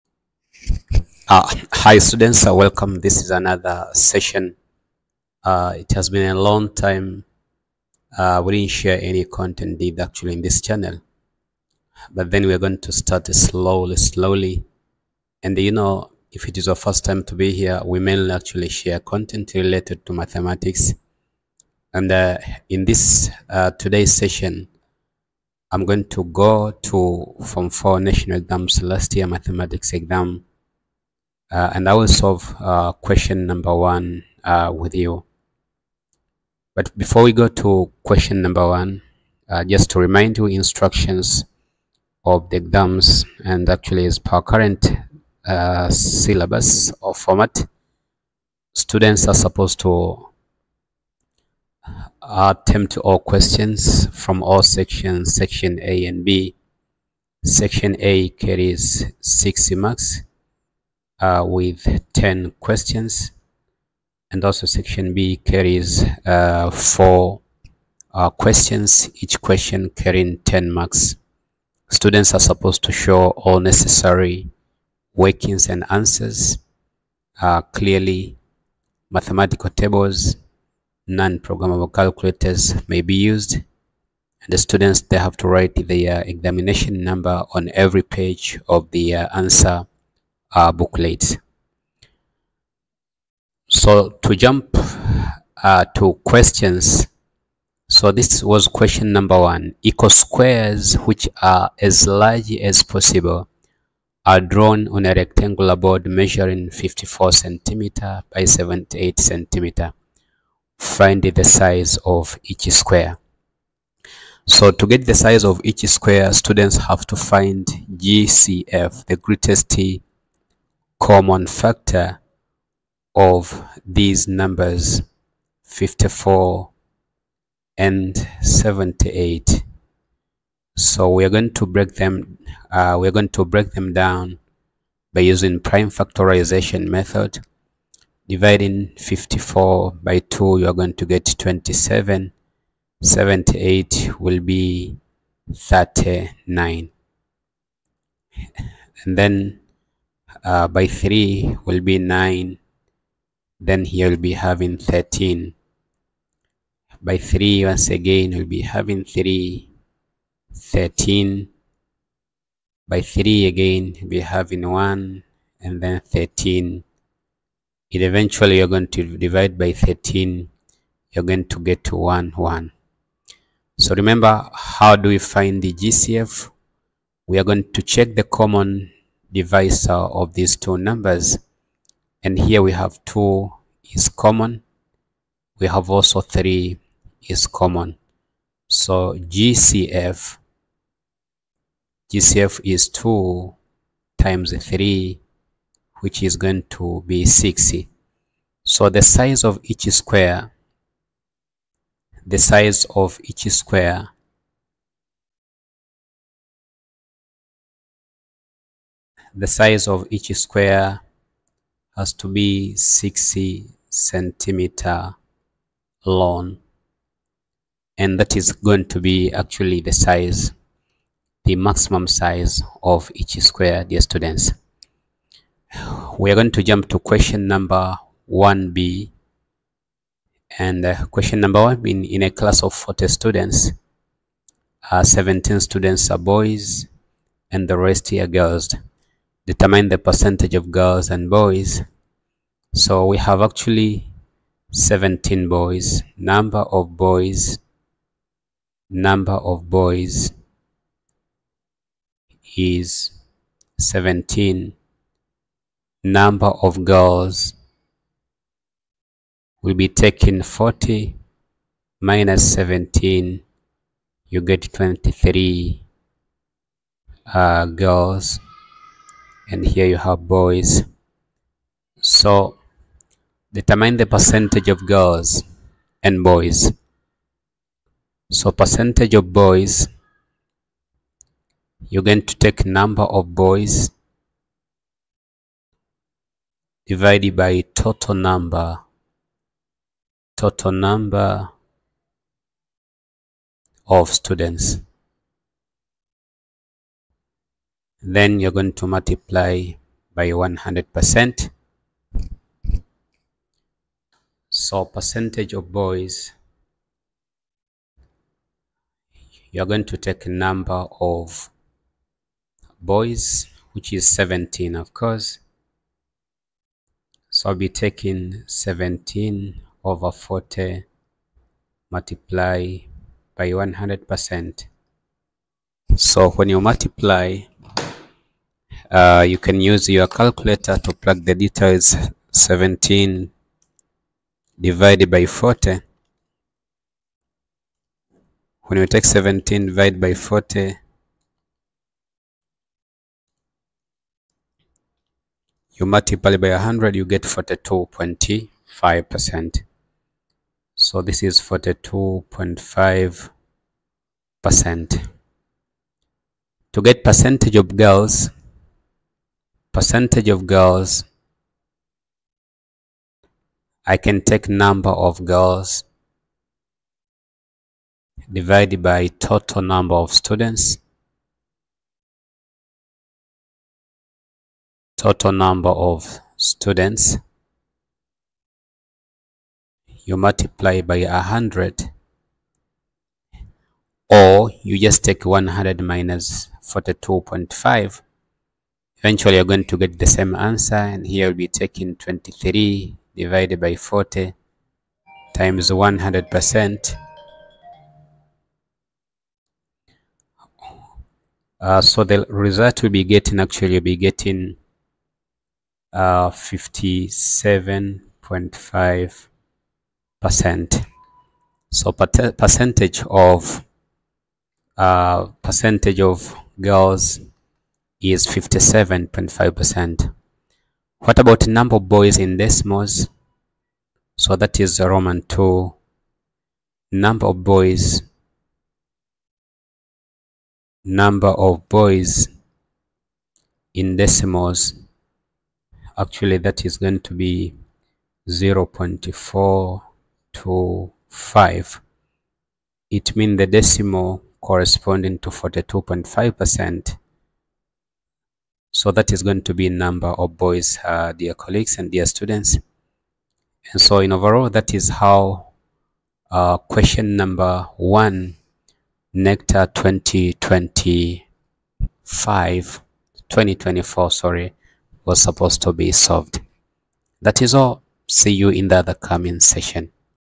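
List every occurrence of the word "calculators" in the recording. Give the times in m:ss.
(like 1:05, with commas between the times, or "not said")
1:21, 5:30.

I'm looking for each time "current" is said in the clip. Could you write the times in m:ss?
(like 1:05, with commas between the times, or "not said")
0:44.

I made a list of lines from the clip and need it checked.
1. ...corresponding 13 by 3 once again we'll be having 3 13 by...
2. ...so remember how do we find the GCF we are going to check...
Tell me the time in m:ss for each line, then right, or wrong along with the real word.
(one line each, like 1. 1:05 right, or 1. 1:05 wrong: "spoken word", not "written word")
1. 2:34 wrong: "having", not "corresponding"
2. 2:53 right.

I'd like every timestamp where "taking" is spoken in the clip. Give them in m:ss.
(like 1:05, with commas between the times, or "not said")
5:17, 6:31.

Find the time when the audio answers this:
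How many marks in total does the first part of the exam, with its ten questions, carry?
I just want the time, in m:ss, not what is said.
0:59.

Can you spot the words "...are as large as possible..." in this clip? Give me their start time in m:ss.
1:41.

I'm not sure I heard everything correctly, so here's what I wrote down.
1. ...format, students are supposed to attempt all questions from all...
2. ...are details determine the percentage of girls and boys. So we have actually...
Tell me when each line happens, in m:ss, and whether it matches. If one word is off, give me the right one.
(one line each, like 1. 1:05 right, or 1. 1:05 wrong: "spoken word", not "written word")
1. 0:47 right
2. 3:58 wrong: "girls", not "details".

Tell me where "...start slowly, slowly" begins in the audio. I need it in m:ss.
0:12.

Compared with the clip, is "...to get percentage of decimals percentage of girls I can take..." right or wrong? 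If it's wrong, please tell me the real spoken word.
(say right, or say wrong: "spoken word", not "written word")
wrong: "girls", not "decimals".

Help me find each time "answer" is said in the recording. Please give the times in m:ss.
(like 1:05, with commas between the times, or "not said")
1:15, 1:29, 6:30.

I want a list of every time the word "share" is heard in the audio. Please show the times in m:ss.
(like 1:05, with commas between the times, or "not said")
0:08, 0:18.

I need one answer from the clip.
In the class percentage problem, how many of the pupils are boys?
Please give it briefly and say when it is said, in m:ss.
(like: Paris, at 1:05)
17, at 3:55.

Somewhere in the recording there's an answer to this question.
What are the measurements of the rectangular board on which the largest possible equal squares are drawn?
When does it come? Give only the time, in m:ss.
1:46.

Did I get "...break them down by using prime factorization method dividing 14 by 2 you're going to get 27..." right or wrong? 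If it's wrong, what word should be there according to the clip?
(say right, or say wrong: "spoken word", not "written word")
wrong: "54", not "14".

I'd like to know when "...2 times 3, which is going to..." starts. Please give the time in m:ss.
3:12.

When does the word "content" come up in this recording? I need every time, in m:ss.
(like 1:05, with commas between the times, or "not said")
0:09, 0:18.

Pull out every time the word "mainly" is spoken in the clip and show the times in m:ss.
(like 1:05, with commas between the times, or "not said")
0:18.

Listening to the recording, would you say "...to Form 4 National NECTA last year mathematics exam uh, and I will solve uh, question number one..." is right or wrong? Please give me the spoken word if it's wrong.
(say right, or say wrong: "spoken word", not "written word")
wrong: "Exams", not "NECTA".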